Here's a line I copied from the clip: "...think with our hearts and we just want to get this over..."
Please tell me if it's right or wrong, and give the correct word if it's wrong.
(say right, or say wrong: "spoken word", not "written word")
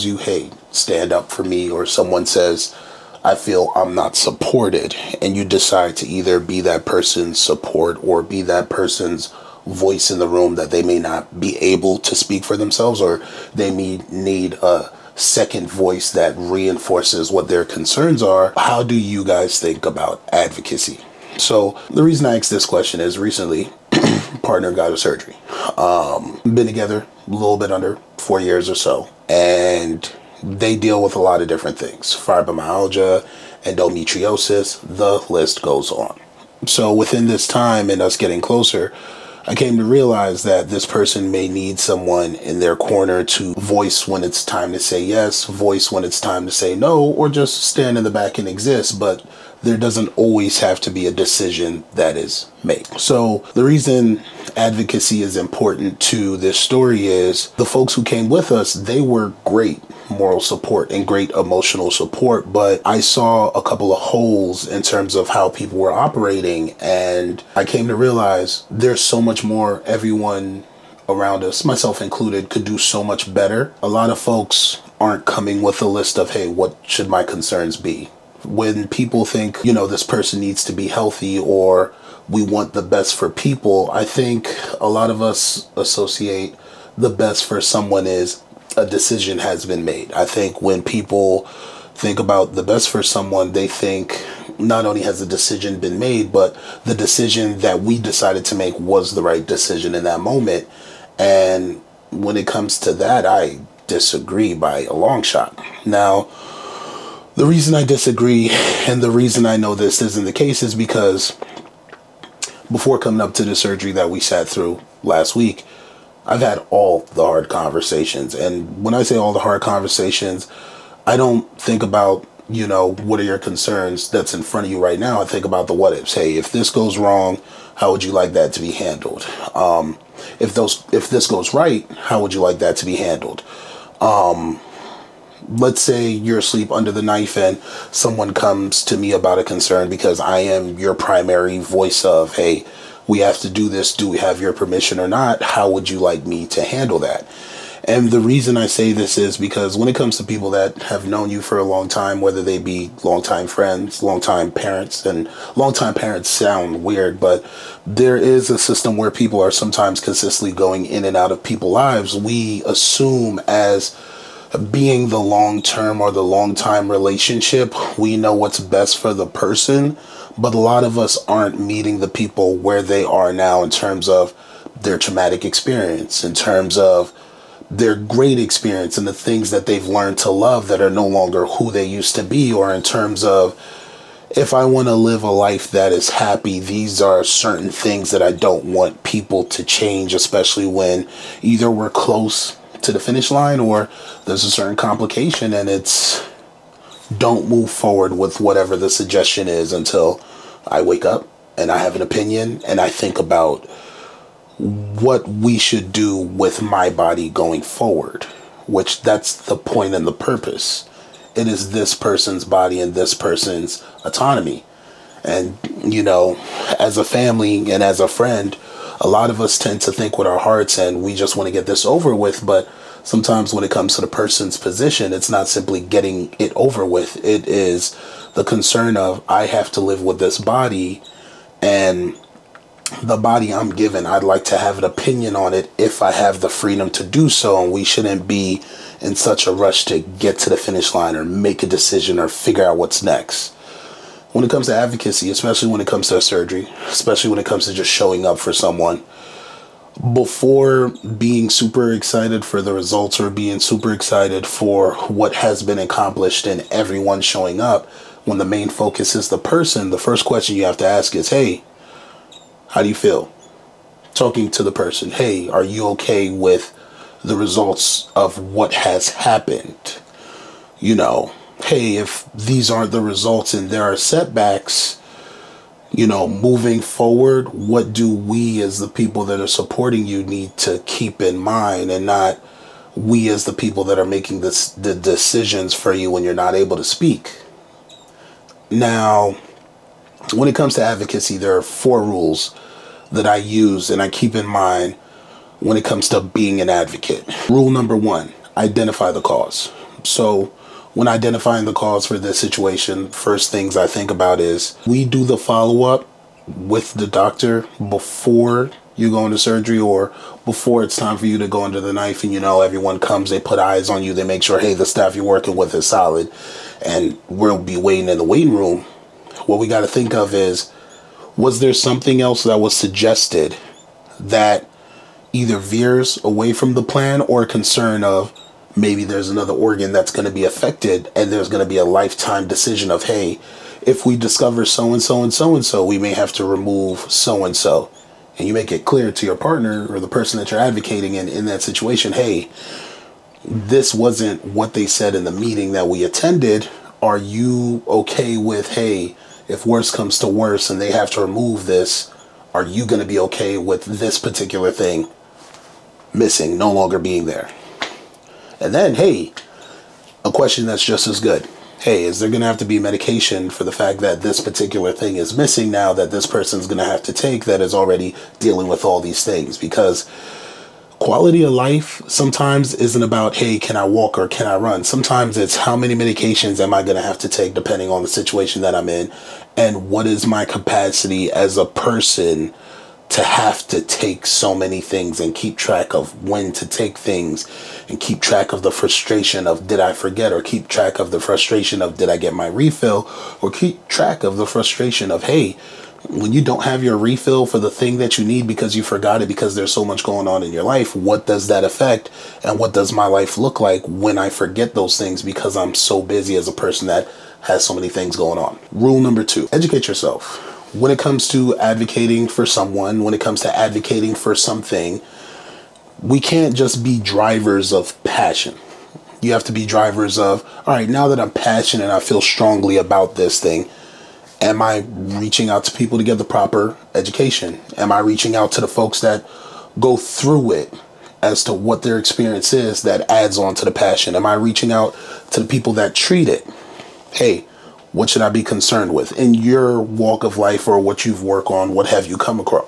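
right.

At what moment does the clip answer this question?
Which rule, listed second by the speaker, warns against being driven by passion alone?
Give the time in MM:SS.
06:49.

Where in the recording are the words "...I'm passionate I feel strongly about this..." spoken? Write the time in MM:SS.
07:01.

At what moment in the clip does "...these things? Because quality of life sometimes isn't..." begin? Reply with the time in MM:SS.
06:09.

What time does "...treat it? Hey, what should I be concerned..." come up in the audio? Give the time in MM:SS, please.
07:15.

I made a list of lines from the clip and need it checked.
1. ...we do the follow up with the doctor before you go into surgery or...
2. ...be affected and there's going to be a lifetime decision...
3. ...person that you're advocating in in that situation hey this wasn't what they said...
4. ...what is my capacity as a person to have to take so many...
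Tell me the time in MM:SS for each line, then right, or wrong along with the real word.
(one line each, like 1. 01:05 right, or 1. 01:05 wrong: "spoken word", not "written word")
1. 05:04 right
2. 05:30 right
3. 05:40 right
4. 06:19 right.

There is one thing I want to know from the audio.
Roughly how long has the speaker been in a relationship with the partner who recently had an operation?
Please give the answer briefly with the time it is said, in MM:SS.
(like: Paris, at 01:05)
Under 4 years, at 00:27.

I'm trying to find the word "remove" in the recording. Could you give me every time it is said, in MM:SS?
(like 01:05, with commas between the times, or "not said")
05:36, 05:51.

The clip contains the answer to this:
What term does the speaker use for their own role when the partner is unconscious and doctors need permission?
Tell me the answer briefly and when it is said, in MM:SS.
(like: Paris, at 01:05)
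Primary voice, at 02:20.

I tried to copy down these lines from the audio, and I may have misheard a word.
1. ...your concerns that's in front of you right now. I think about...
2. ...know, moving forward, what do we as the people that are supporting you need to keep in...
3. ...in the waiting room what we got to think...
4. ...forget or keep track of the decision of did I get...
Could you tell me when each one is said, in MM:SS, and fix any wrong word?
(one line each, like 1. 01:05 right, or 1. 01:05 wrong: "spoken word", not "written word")
1. 02:03 right
2. 04:36 right
3. 05:18 right
4. 06:29 wrong: "frustration", not "decision".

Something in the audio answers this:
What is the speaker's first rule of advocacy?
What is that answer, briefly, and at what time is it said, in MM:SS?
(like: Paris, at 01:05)
Identify the cause, at 04:58.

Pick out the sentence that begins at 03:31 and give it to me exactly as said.
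It is this person's body and this person's autonomy.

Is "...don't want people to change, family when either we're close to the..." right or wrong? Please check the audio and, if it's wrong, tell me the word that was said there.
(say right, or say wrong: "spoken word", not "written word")
wrong: "especially", not "family".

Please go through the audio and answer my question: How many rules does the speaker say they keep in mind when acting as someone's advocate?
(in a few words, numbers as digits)
4.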